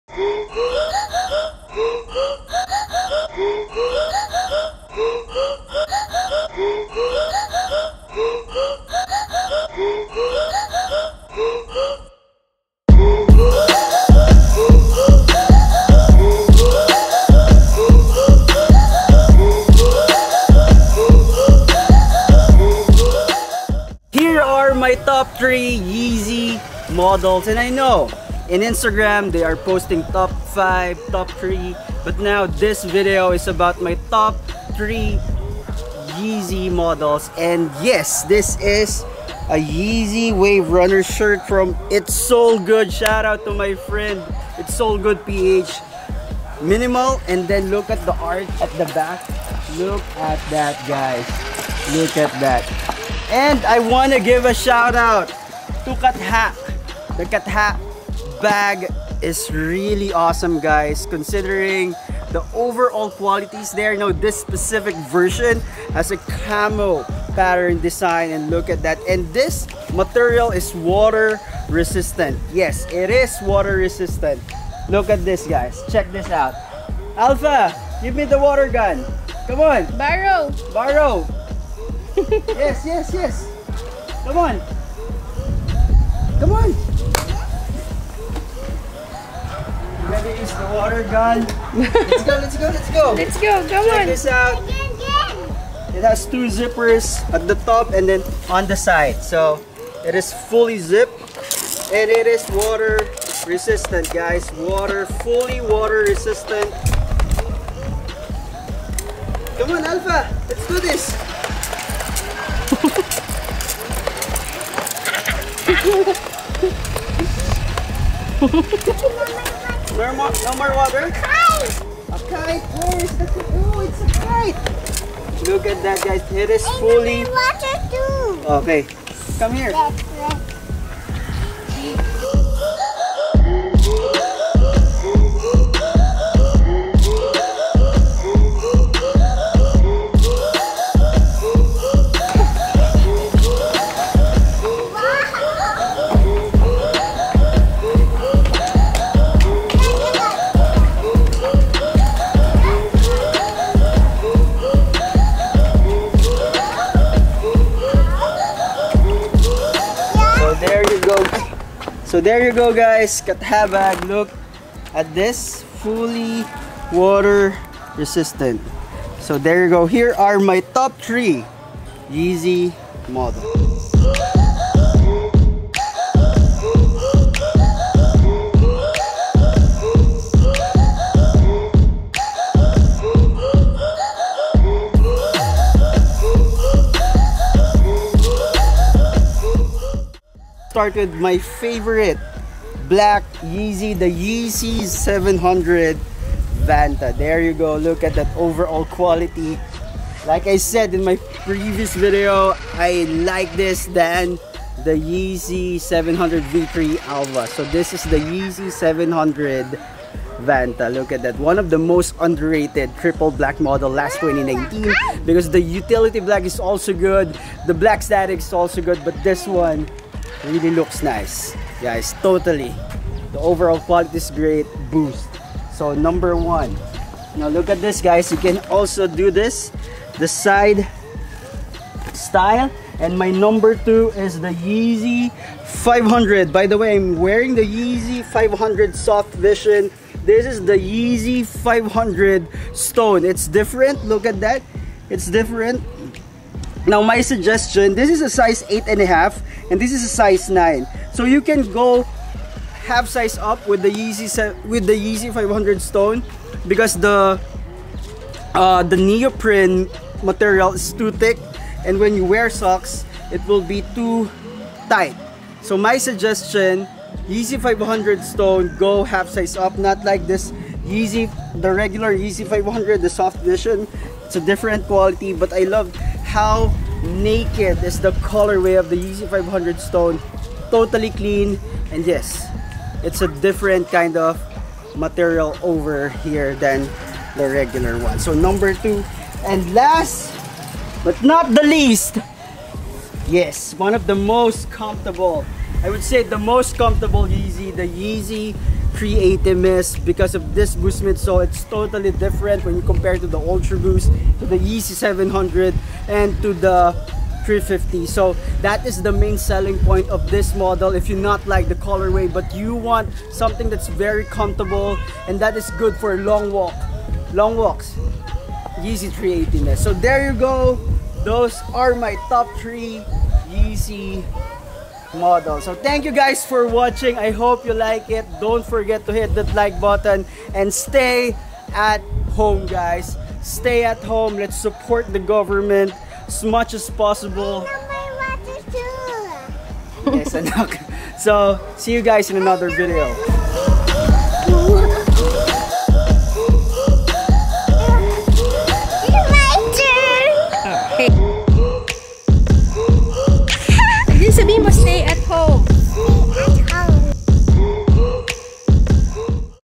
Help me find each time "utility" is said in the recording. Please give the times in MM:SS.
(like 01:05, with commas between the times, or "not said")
03:35.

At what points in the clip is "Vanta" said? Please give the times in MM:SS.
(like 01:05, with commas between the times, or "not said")
03:16, 03:30.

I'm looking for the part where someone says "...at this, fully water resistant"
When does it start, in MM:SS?
02:44.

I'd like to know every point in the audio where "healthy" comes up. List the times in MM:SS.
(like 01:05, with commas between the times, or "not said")
not said.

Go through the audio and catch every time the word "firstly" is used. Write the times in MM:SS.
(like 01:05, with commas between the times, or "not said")
not said.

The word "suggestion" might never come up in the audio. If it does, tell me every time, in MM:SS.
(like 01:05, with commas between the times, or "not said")
04:07, 04:26.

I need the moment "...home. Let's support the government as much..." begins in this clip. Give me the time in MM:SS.
05:33.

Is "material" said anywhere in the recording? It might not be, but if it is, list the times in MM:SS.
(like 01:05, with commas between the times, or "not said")
01:09, 04:20, 04:44.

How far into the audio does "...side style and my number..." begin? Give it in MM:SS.
03:50.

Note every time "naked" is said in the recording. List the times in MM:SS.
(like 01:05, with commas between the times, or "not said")
04:37.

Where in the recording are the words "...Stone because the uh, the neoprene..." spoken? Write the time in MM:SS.
04:15.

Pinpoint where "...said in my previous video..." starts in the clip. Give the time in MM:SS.
03:20.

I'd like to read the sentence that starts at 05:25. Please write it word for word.
So thank you guys for watching.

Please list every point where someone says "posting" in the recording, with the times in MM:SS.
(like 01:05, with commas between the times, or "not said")
00:29.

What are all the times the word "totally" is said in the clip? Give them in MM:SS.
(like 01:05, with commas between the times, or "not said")
03:42, 04:40, 05:01.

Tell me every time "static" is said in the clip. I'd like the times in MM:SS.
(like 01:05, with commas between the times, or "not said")
03:38.